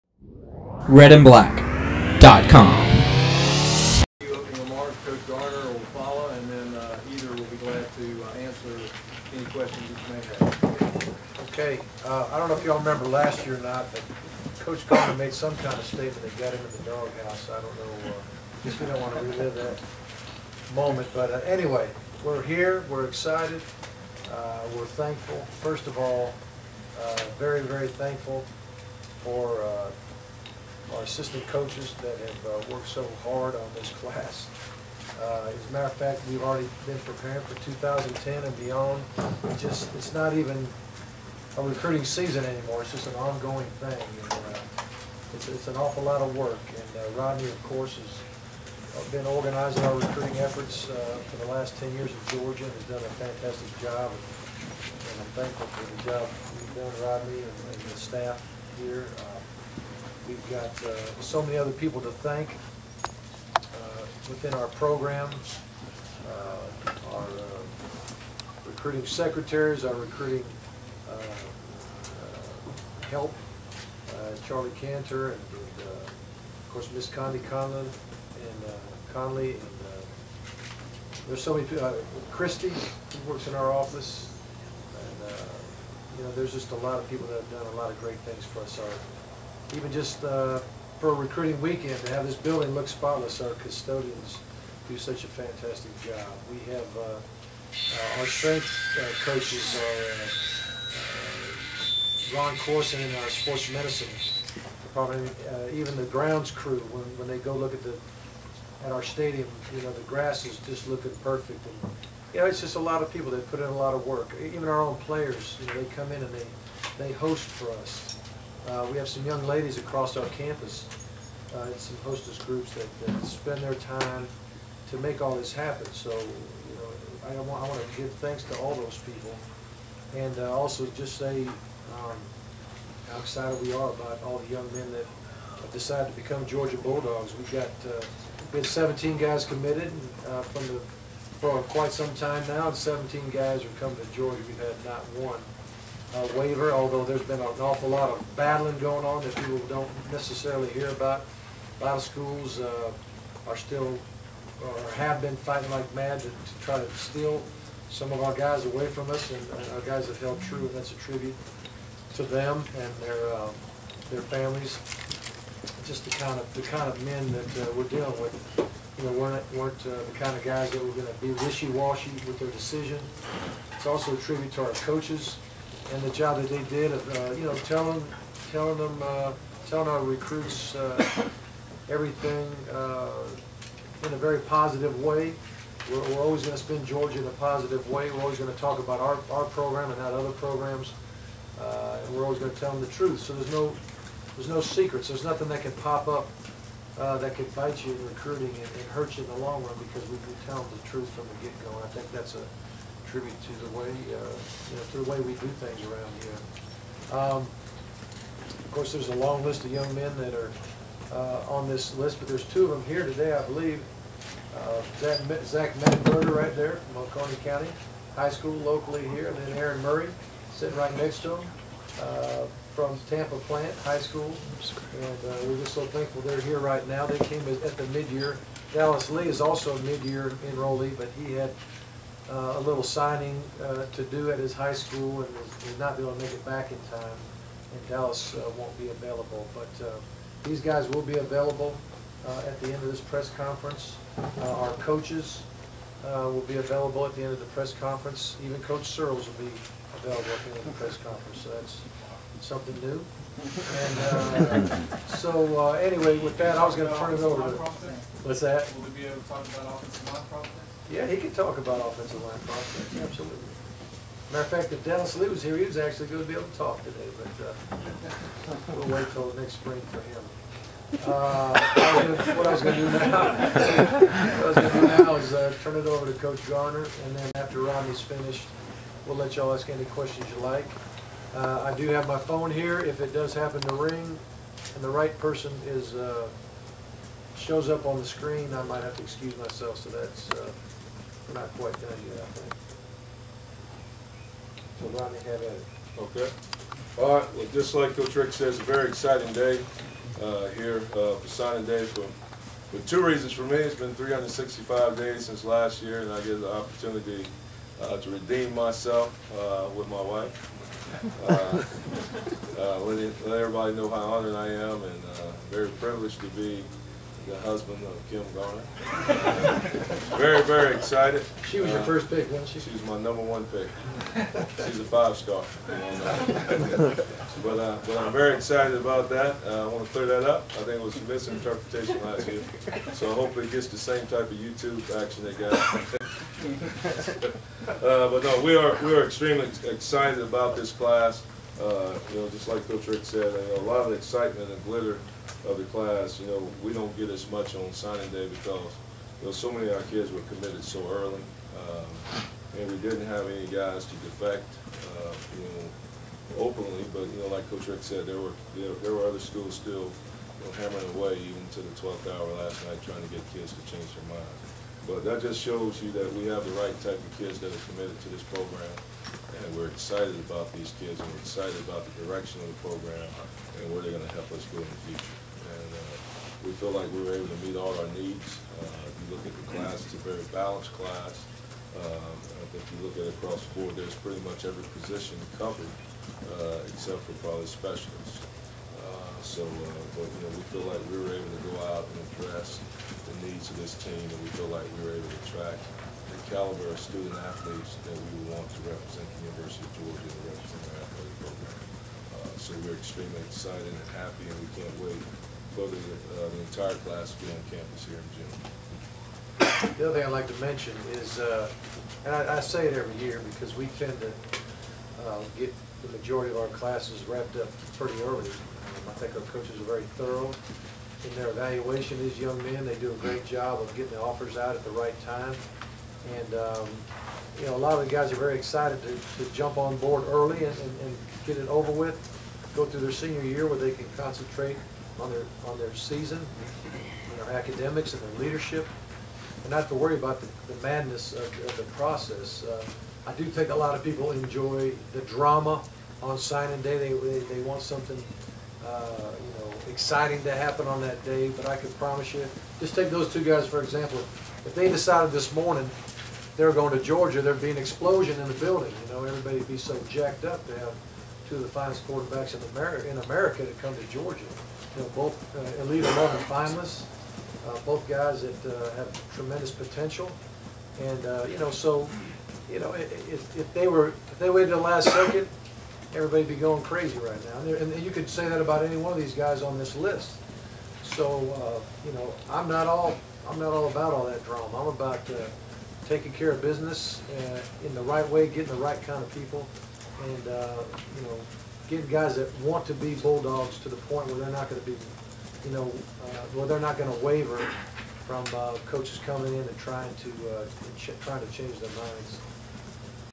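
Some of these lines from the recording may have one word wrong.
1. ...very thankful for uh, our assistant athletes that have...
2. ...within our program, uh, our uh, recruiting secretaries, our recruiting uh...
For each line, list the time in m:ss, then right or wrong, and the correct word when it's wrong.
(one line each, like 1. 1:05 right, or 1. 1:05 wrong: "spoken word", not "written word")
1. 0:27 wrong: "coaches", not "athletes"
2. 1:04 right.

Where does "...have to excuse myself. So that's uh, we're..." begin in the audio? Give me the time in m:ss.
4:48.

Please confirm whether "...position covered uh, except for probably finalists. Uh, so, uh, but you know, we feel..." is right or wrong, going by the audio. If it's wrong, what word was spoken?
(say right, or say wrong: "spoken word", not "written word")
wrong: "specialists", not "finalists".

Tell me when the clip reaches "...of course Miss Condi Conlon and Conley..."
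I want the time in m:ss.
1:15.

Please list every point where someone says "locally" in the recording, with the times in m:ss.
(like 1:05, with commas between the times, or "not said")
3:38.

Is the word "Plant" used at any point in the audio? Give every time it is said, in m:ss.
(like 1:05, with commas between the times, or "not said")
3:43.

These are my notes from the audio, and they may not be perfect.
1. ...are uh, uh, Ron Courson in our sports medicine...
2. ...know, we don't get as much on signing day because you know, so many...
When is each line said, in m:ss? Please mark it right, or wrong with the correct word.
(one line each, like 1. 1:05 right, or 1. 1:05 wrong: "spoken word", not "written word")
1. 1:42 right
2. 5:46 right.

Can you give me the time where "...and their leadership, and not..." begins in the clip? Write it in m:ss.
7:17.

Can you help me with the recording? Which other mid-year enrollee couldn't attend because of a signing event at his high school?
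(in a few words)
Dallas Lee.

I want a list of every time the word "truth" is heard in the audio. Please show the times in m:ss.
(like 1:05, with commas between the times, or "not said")
3:12, 3:20.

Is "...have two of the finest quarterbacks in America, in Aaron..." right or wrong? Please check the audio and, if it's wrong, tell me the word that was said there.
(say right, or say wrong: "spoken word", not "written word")
wrong: "America", not "Aaron".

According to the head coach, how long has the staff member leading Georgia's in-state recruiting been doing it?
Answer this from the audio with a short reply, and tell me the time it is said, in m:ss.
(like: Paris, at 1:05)
10 years, at 0:51.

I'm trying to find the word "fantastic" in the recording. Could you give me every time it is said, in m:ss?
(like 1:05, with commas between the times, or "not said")
0:53, 1:35.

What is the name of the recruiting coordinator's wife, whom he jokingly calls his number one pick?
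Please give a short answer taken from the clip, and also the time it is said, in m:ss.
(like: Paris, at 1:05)
Kim Garner, at 5:18.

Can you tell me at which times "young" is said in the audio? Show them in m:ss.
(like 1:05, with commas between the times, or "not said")
1:59, 2:14, 3:29, 7:02.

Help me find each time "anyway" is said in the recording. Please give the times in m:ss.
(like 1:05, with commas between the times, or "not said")
0:21, 4:15.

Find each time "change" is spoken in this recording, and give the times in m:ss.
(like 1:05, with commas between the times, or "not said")
6:03, 8:21.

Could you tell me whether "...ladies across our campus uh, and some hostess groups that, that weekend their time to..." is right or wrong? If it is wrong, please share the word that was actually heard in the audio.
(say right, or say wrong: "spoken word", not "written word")
wrong: "spend", not "weekend".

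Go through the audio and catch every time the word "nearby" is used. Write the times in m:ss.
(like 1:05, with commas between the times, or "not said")
not said.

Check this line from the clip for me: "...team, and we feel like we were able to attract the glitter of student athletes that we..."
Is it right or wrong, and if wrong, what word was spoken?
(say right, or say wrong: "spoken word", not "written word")
wrong: "caliber", not "glitter".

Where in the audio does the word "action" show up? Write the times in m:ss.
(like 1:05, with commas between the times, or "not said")
5:35.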